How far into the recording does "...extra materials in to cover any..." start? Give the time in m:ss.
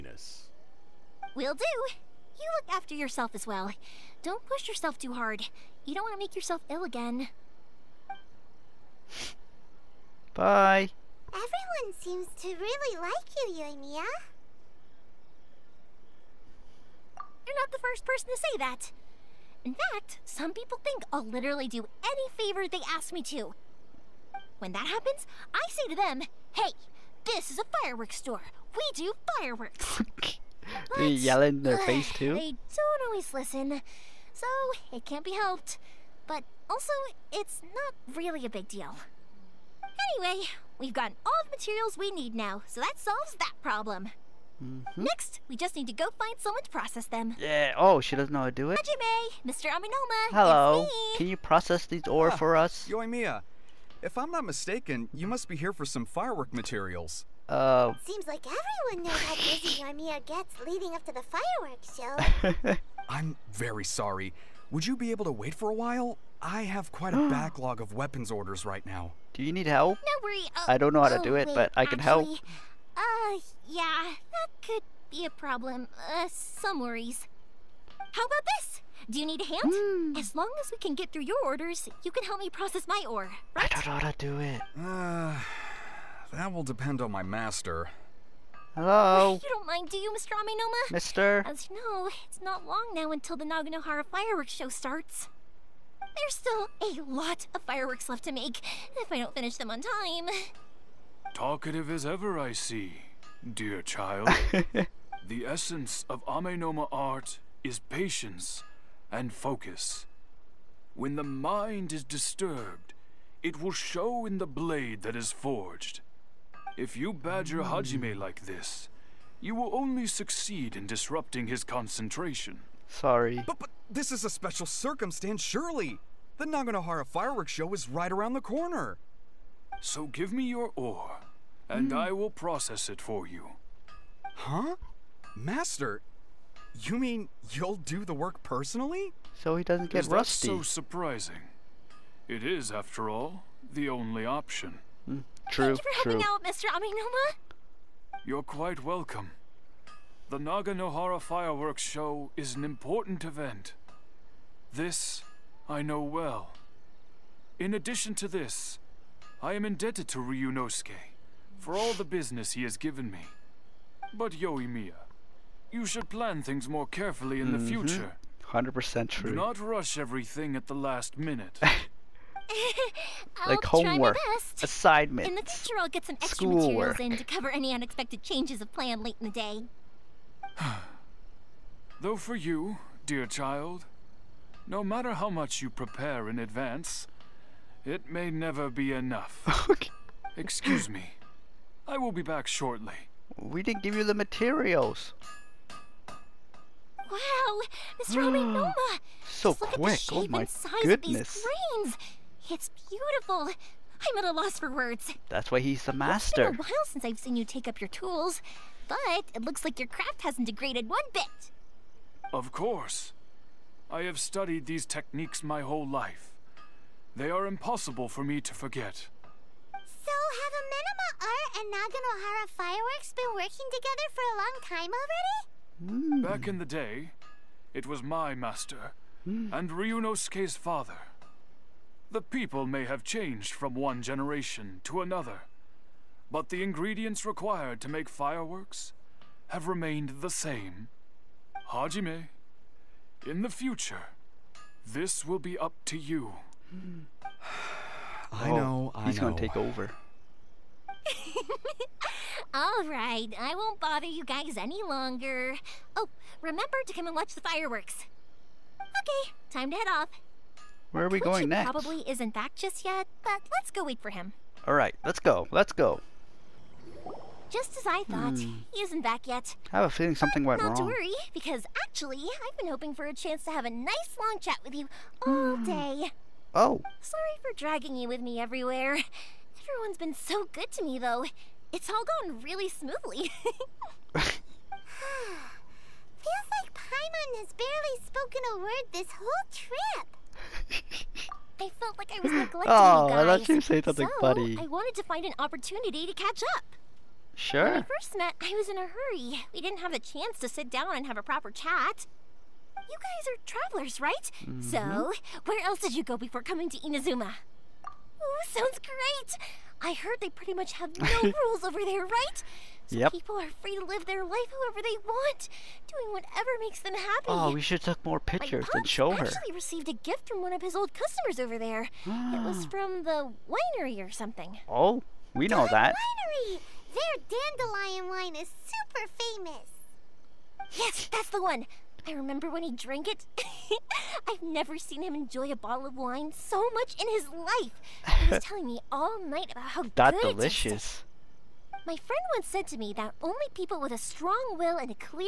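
2:56.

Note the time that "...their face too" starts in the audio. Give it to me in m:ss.
0:31.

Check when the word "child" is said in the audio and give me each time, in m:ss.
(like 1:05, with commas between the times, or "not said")
1:43, 3:03.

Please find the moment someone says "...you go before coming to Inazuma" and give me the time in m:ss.
5:05.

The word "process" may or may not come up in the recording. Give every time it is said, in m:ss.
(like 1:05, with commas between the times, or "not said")
0:46, 0:51, 1:22, 2:12.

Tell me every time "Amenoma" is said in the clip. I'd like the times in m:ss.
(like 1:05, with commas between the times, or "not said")
0:49, 1:30, 1:46, 2:26, 3:18, 3:40.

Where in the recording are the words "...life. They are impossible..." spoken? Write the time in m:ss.
3:35.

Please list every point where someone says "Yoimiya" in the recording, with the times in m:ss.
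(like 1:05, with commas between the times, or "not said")
0:13, 0:52, 0:59, 2:44.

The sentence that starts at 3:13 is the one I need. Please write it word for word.
We didn't give you the materials.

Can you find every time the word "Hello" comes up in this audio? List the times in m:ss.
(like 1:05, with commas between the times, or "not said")
0:50, 1:28.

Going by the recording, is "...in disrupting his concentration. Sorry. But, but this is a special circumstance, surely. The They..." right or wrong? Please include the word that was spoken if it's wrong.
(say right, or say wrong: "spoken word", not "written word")
wrong: "Naganohara", not "They".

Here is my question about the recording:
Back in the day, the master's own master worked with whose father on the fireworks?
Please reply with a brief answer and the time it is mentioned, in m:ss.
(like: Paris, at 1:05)
Ryunosuke's father, at 3:49.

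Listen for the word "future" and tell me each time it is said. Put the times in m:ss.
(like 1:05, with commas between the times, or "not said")
2:47, 2:55, 4:03.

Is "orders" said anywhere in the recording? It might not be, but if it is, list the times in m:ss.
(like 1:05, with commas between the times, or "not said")
1:08, 1:21.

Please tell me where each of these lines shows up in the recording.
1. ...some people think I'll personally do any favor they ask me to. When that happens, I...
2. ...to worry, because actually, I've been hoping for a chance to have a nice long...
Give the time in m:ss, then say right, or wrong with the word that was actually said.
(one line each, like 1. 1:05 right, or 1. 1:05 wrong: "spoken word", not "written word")
1. 0:20 wrong: "literally", not "personally"
2. 4:30 right.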